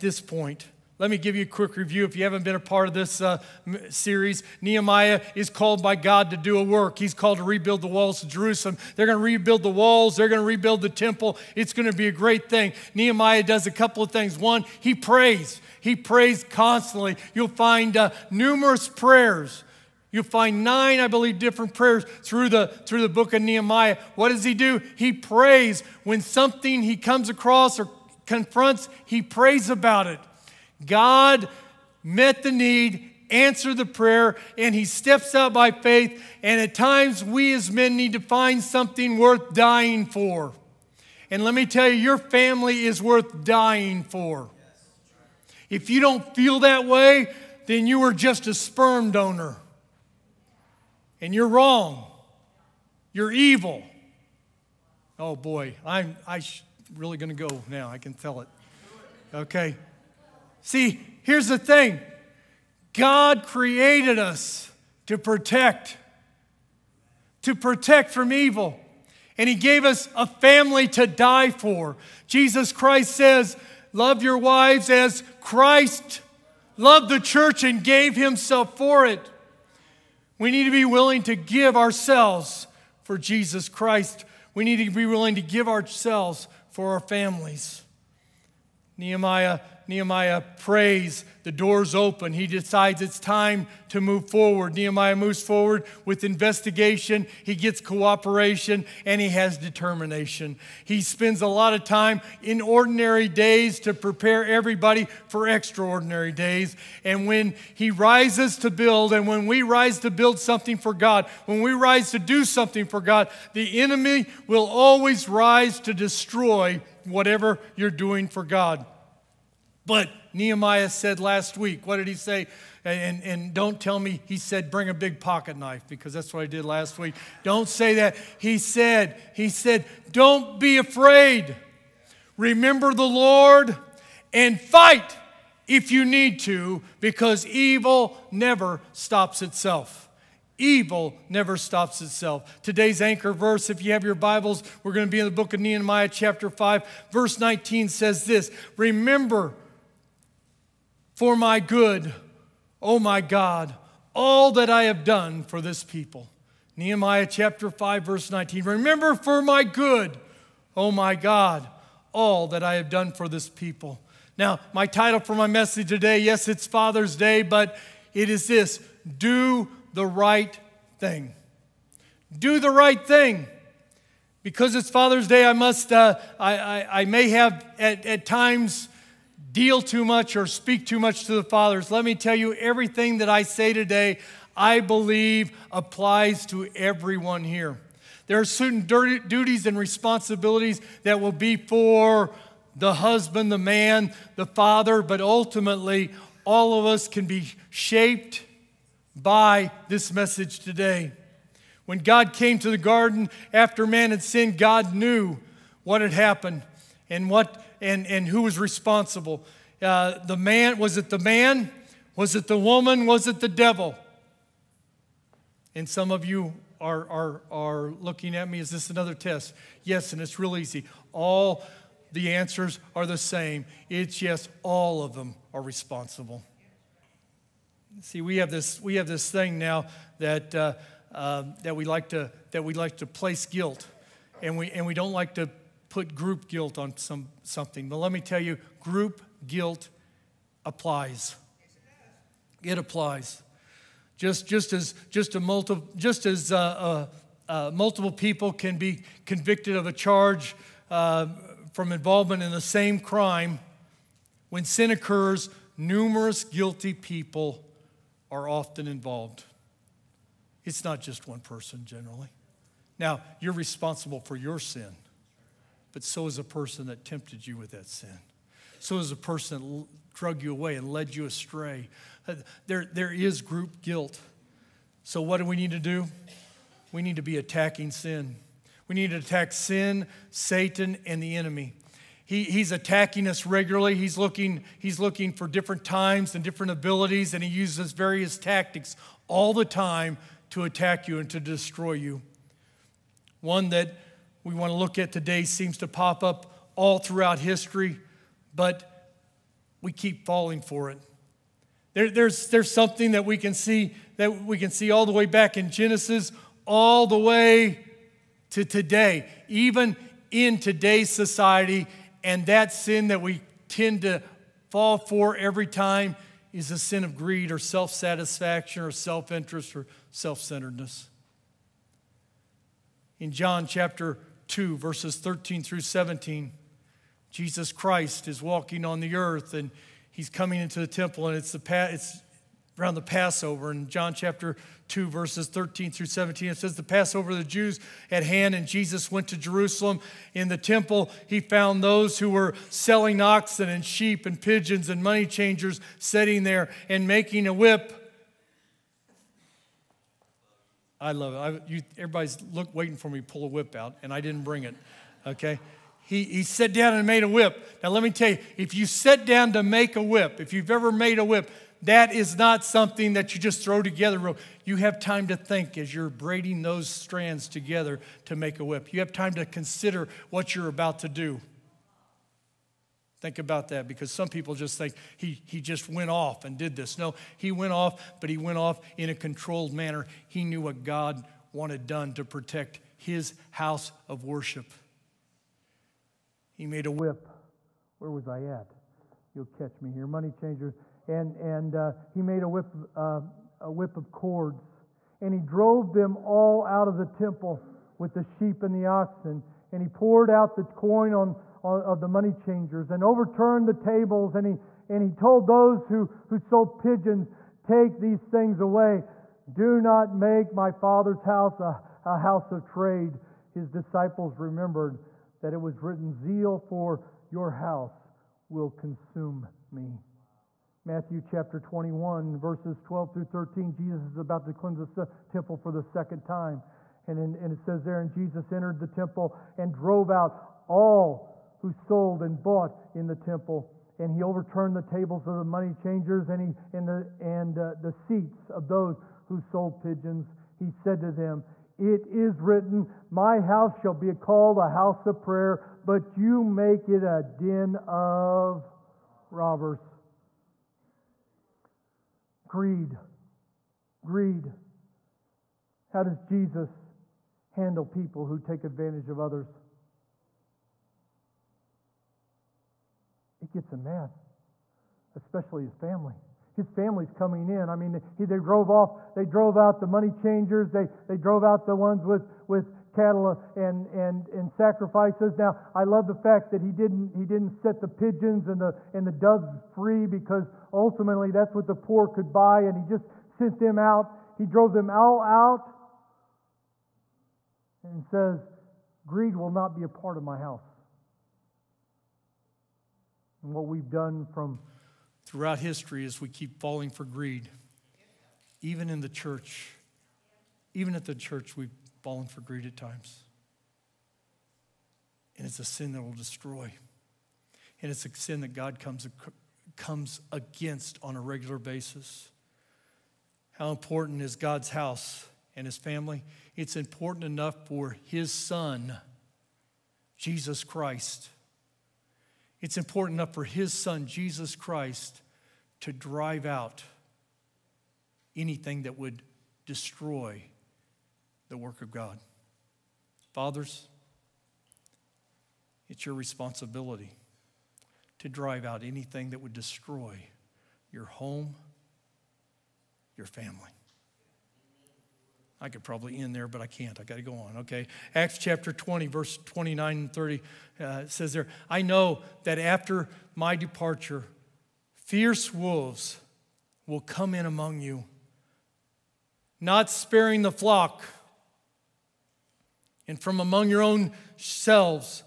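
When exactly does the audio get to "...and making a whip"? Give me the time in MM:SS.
05:46.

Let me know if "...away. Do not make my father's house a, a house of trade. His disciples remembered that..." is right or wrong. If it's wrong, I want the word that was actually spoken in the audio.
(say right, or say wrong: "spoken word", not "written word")
right.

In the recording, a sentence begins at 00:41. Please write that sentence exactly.
And let me tell you, your family is worth dying for.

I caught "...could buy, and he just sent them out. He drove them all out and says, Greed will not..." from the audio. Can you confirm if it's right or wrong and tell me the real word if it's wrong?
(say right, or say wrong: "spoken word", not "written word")
right.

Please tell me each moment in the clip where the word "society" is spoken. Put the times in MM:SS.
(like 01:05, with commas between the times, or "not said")
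05:11.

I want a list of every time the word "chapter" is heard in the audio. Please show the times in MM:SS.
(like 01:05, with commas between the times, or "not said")
02:26, 02:37, 05:23, 05:34, 07:01, 09:08.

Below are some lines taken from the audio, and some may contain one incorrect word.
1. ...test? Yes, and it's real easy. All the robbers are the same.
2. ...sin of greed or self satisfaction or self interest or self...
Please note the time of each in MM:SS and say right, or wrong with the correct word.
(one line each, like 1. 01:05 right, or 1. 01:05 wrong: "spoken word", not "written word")
1. 03:39 wrong: "answers", not "robbers"
2. 05:16 right.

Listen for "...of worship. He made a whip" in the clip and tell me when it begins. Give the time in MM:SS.
06:24.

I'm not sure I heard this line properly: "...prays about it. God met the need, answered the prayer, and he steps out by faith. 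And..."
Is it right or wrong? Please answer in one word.
right.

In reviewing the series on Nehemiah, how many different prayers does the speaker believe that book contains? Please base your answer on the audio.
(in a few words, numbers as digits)
9.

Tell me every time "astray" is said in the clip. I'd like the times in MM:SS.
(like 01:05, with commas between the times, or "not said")
04:31.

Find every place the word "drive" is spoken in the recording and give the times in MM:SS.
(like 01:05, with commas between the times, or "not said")
08:45, 08:58.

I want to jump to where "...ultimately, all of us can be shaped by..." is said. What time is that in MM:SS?
03:15.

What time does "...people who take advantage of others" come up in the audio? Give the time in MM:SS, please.
07:37.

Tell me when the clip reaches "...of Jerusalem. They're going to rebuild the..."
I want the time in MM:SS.
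00:08.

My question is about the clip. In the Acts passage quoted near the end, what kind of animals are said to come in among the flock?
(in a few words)
Fierce wolves.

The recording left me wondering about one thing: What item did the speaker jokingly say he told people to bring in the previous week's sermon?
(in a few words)
A big pocket knife.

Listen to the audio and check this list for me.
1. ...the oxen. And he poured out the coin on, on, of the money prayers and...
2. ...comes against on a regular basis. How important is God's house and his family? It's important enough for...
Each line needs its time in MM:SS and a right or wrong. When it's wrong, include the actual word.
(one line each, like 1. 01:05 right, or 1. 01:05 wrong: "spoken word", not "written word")
1. 06:38 wrong: "changers", not "prayers"
2. 08:29 right.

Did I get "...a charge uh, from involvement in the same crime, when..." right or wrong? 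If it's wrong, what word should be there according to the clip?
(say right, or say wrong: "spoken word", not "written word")
right.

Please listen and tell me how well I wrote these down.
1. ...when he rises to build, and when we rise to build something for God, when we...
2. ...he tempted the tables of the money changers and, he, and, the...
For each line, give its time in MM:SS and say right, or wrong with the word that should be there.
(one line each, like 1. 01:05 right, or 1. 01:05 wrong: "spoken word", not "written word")
1. 01:47 right
2. 07:14 wrong: "overturned", not "tempted".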